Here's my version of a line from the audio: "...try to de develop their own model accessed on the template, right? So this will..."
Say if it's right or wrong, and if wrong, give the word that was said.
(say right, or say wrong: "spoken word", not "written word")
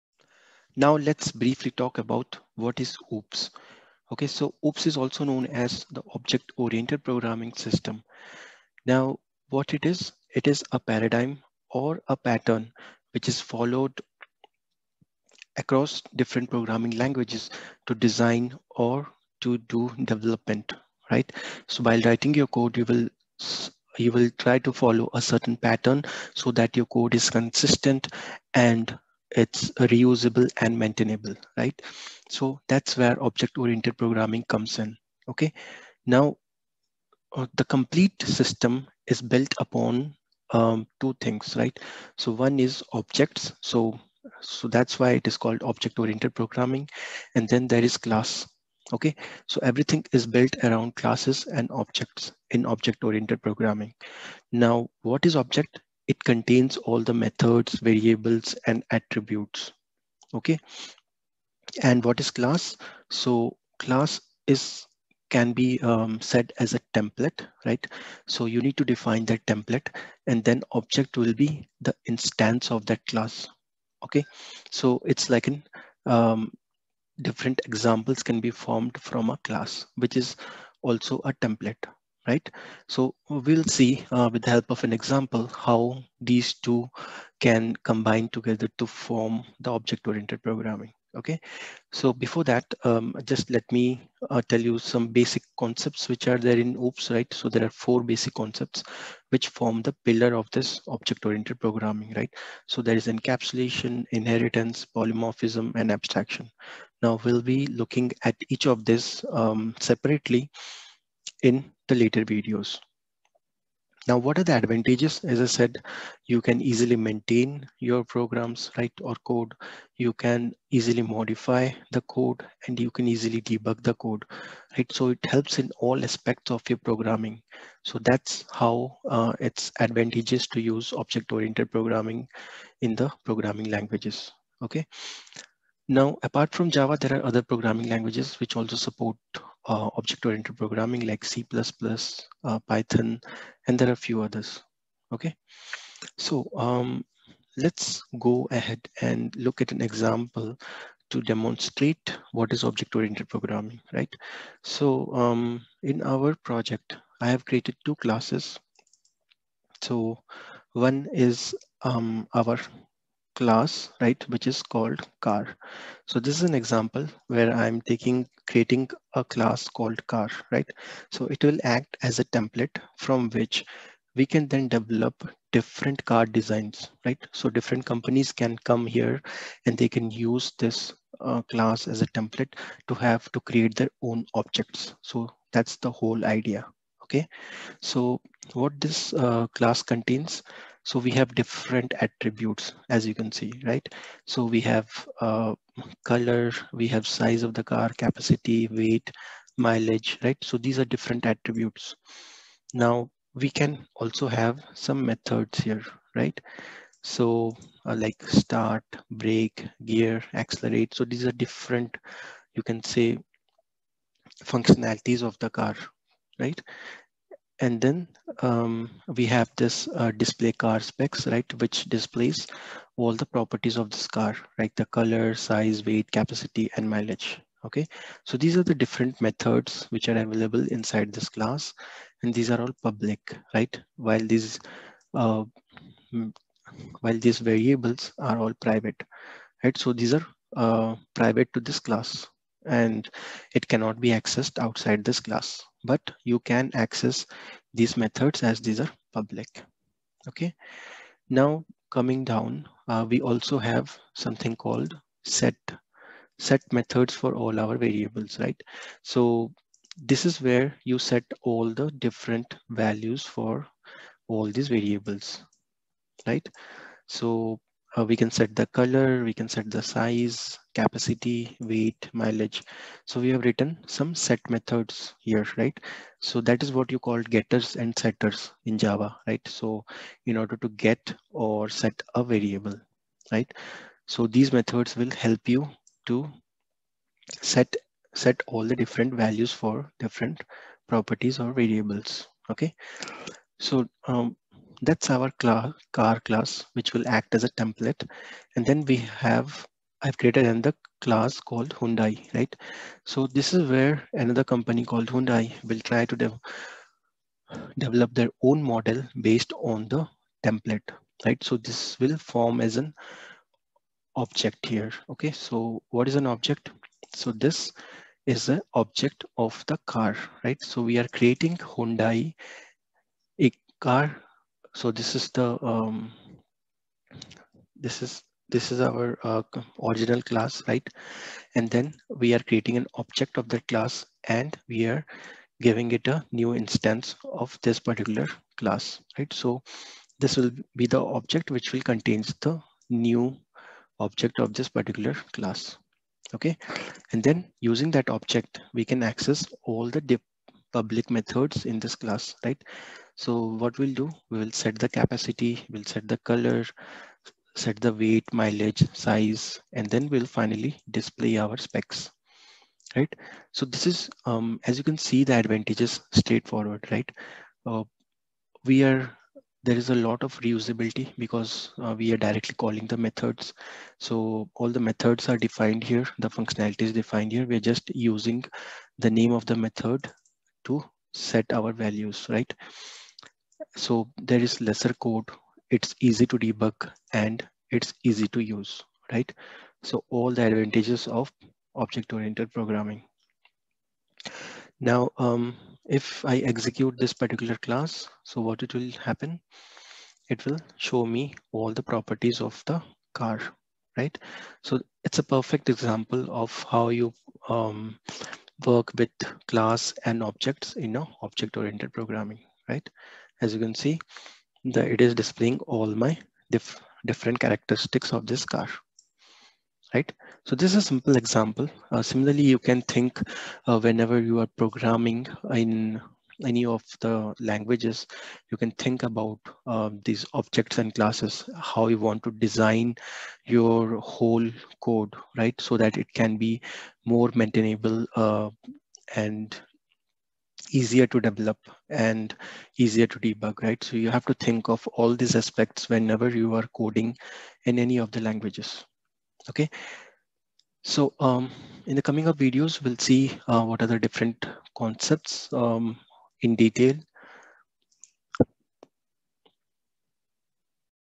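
wrong: "based", not "accessed".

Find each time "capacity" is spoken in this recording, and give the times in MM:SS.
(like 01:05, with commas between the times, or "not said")
03:17, 03:46, 04:30, 05:54.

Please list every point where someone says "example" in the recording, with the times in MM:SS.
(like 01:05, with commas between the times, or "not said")
01:17, 01:24, 02:29, 02:46, 06:45, 07:01.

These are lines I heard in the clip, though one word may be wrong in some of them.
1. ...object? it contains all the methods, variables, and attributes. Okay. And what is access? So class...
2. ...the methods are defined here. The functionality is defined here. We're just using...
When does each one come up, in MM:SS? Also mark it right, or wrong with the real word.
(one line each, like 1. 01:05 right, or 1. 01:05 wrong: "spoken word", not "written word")
1. 00:55 wrong: "class", not "access"
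2. 06:14 right.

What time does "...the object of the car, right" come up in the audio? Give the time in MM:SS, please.
05:18.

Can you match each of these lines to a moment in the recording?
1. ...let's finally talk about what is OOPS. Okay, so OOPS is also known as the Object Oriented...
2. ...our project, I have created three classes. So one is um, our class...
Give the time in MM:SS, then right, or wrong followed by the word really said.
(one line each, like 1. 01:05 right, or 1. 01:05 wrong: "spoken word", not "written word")
1. 00:00 wrong: "briefly", not "finally"
2. 02:36 wrong: "two", not "three".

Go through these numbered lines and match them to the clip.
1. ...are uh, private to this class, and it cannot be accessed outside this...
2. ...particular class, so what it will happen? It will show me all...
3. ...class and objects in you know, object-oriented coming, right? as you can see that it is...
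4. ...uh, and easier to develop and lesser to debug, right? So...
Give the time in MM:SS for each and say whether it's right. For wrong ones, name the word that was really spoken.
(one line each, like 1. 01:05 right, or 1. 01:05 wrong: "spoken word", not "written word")
1. 04:00 right
2. 06:37 right
3. 06:49 wrong: "programming", not "coming"
4. 07:18 wrong: "easier", not "lesser".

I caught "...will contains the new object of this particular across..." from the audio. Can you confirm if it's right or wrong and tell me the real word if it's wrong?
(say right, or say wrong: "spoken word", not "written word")
wrong: "class", not "across".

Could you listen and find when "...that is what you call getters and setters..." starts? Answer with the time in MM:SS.
04:36.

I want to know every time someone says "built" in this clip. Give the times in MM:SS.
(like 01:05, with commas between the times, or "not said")
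00:39, 00:50.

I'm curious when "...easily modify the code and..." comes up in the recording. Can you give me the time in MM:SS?
02:00.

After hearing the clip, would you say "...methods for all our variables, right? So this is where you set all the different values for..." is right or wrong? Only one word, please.
right.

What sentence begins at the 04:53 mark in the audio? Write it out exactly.
So um, that's our class, car class, which will act as a template.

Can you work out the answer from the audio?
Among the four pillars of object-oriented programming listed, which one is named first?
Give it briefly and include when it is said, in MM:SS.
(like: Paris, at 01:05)
Encapsulation, at 01:43.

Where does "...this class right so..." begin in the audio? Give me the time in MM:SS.
05:51.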